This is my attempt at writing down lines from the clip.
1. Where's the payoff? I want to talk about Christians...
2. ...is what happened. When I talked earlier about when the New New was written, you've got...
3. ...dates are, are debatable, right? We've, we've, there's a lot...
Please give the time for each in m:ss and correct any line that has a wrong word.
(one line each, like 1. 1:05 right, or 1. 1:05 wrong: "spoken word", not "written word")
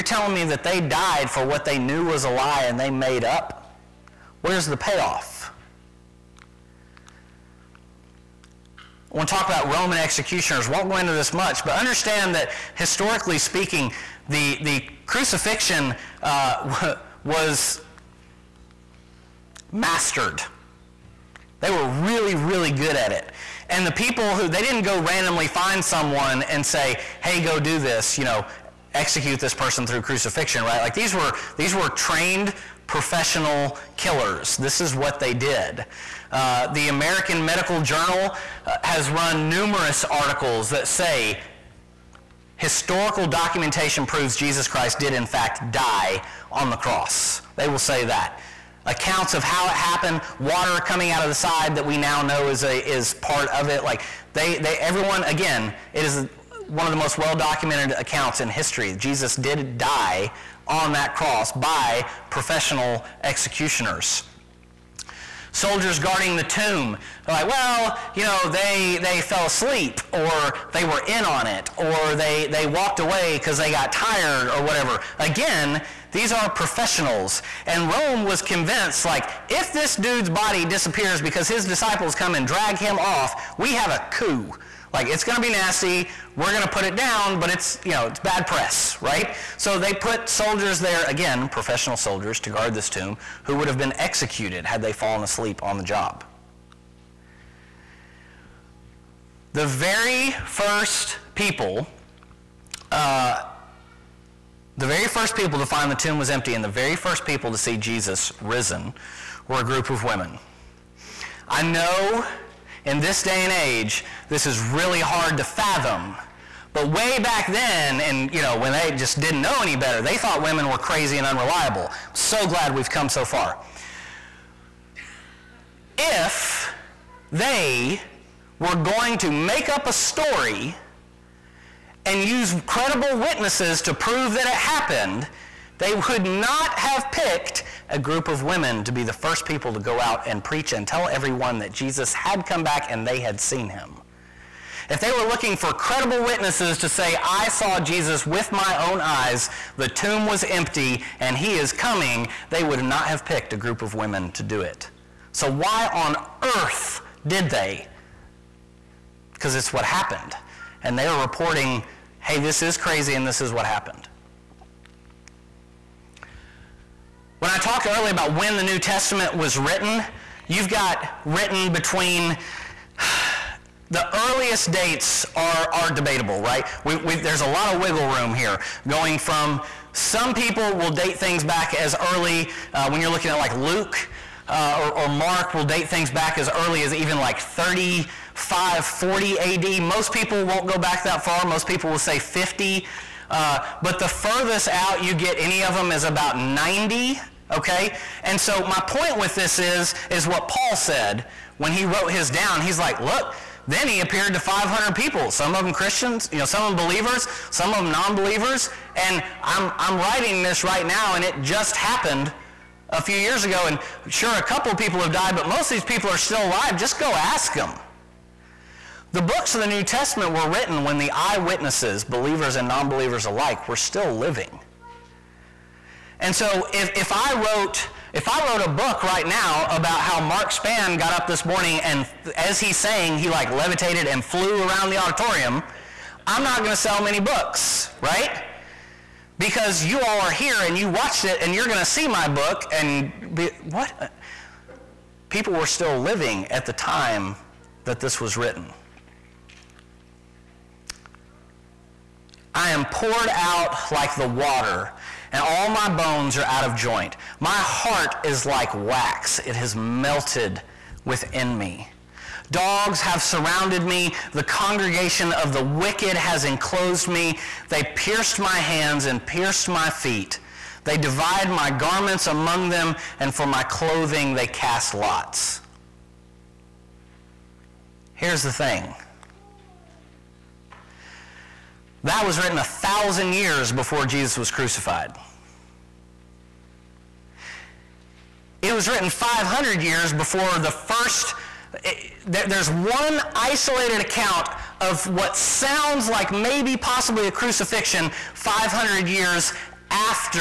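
1. 0:04 wrong: "Roman", not "Christians"
2. 2:43 wrong: "Testament", not "New"
3. 2:54 right.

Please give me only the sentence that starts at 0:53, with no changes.
Like they, they, everyone, again, it is one of the most well documented accounts in history.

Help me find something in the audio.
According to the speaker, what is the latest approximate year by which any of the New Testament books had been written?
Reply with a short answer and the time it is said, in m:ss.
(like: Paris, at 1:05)
90, at 3:16.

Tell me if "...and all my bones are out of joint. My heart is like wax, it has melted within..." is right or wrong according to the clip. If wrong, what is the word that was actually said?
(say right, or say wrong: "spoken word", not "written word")
right.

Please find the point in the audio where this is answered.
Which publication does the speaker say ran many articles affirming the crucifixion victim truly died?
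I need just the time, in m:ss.
0:36.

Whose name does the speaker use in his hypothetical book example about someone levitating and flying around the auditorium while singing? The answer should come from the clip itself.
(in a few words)
Mark Spann.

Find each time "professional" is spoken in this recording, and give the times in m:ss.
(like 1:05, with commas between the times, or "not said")
0:32, 1:02, 1:16, 1:31.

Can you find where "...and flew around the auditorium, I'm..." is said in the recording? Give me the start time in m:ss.
3:54.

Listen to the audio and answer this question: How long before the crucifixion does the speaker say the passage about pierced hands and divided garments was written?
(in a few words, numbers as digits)
A thousand years.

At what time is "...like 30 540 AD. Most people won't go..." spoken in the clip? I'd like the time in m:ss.
3:07.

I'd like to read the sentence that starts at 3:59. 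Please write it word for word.
Because you all are here and you watched it and you're going to see my book and be, what?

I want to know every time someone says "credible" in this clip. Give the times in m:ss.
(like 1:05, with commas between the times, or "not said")
2:12, 2:25.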